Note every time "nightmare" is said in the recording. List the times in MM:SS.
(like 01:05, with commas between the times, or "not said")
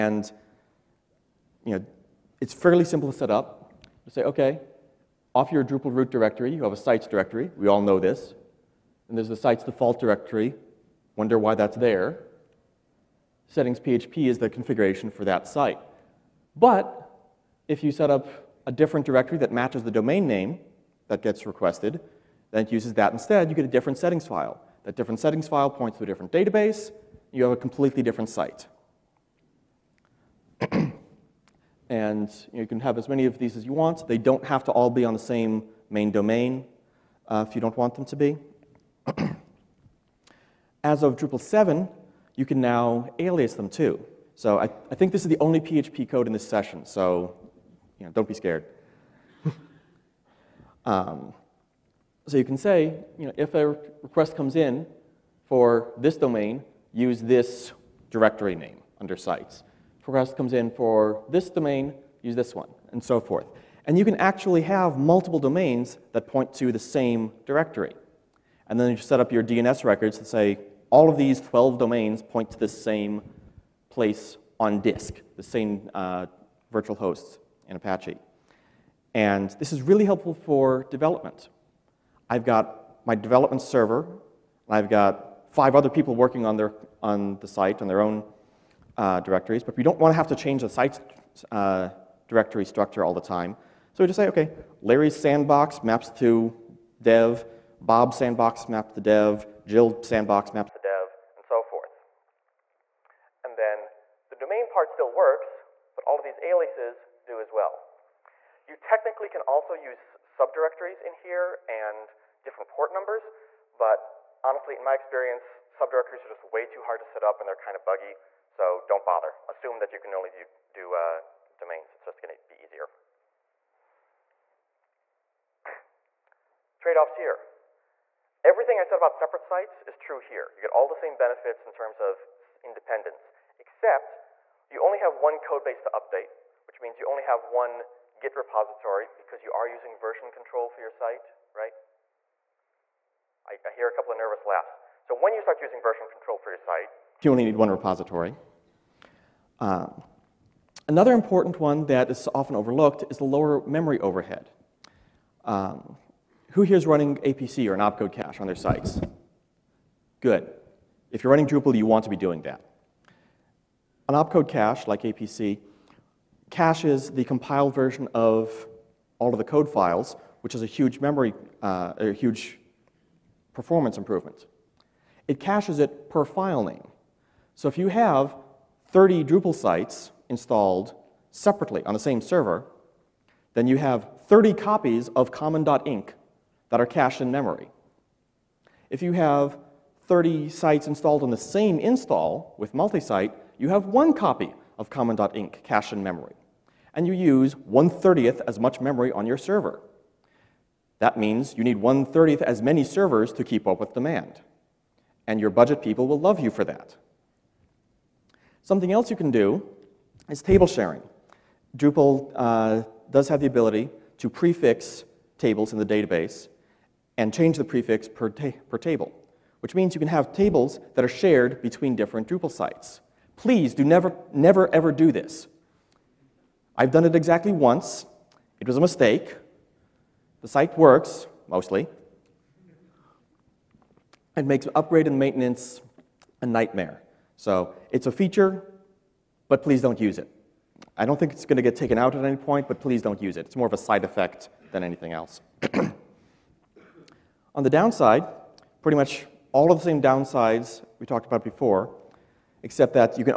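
03:56.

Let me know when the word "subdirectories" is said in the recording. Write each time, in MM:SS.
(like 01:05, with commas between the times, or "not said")
01:50, 01:55.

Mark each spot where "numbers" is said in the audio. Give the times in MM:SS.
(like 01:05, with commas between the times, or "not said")
01:52.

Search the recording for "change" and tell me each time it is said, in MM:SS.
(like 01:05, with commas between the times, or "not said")
01:30, 03:37.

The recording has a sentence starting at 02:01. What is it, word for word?
It's just going to be easier.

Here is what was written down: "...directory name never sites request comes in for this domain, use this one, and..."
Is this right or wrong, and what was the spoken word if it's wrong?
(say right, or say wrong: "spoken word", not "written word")
wrong: "under", not "never".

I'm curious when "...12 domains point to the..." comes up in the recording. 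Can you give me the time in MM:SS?
01:11.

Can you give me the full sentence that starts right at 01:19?
And this is really helpful for development.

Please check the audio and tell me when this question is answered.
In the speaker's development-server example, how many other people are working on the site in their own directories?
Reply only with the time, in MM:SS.
01:25.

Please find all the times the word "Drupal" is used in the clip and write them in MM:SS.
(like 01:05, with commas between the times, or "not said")
00:05, 00:41, 02:41, 02:59, 03:31, 03:42.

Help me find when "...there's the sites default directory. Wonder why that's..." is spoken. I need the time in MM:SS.
00:09.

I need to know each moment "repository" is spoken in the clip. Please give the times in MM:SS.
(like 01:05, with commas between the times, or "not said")
02:18, 02:27.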